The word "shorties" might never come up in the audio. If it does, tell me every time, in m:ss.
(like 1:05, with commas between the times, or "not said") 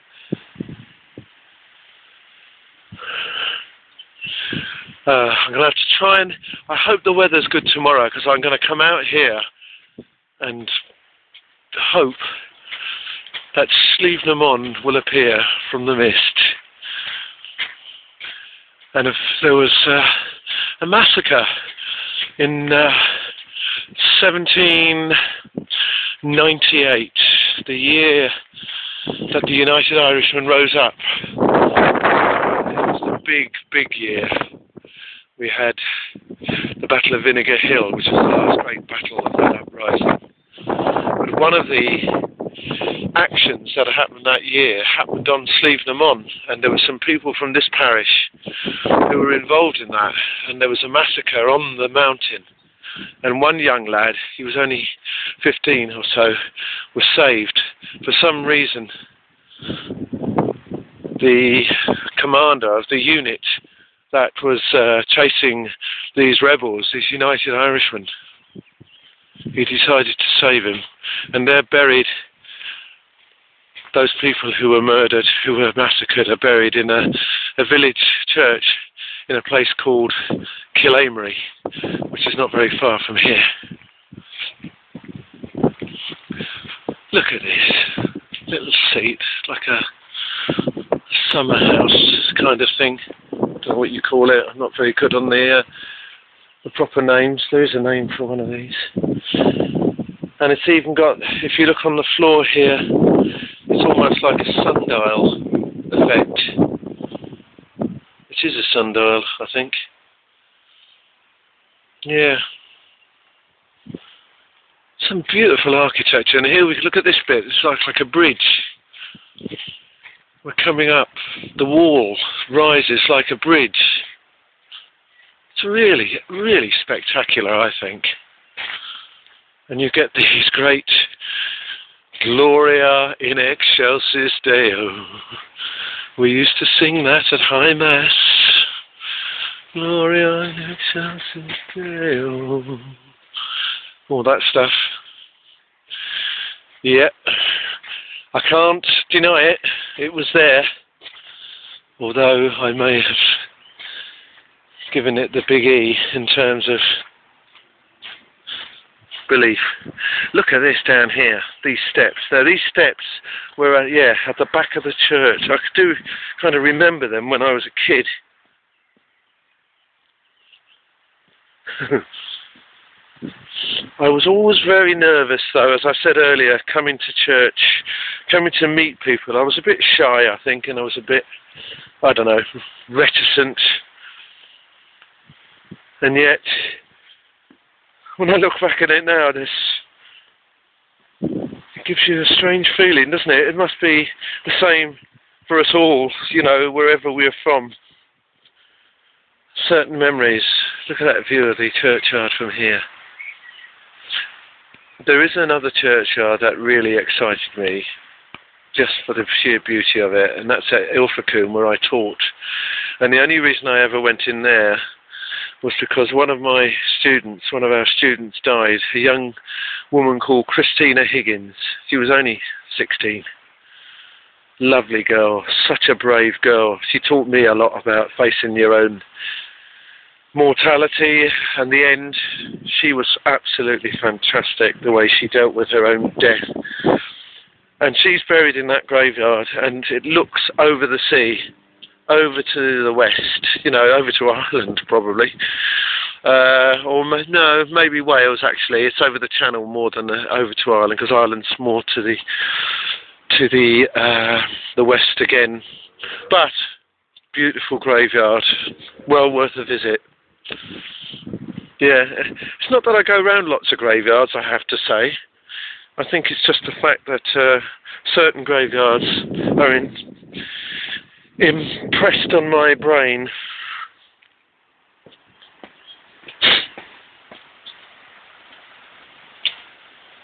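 not said.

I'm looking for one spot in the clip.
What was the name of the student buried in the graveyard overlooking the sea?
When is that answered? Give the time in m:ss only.
3:40.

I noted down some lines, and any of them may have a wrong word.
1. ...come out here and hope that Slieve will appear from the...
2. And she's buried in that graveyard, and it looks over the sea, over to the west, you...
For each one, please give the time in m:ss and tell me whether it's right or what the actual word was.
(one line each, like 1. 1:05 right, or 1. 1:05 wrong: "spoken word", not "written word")
1. 0:08 right
2. 3:57 right.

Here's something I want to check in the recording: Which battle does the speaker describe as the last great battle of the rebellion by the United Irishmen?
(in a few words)
Battle of Vinegar Hill.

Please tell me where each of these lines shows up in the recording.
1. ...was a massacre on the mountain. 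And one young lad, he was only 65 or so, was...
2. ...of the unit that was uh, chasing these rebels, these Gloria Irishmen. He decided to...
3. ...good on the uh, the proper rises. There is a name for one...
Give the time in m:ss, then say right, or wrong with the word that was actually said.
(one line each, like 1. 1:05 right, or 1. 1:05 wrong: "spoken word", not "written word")
1. 0:50 wrong: "15", not "65"
2. 1:02 wrong: "United", not "Gloria"
3. 1:34 wrong: "names", not "rises".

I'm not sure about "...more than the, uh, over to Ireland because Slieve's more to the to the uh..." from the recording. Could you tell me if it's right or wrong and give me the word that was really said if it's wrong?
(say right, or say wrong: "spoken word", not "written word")
wrong: "Ireland", not "Slieve".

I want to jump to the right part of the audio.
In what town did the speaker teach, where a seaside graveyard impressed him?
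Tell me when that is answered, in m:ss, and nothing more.
3:30.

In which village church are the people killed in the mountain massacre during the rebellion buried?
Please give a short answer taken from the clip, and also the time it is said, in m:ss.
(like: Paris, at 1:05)
Killamery, at 1:20.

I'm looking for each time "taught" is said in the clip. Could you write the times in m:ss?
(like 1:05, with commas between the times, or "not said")
3:31, 3:46.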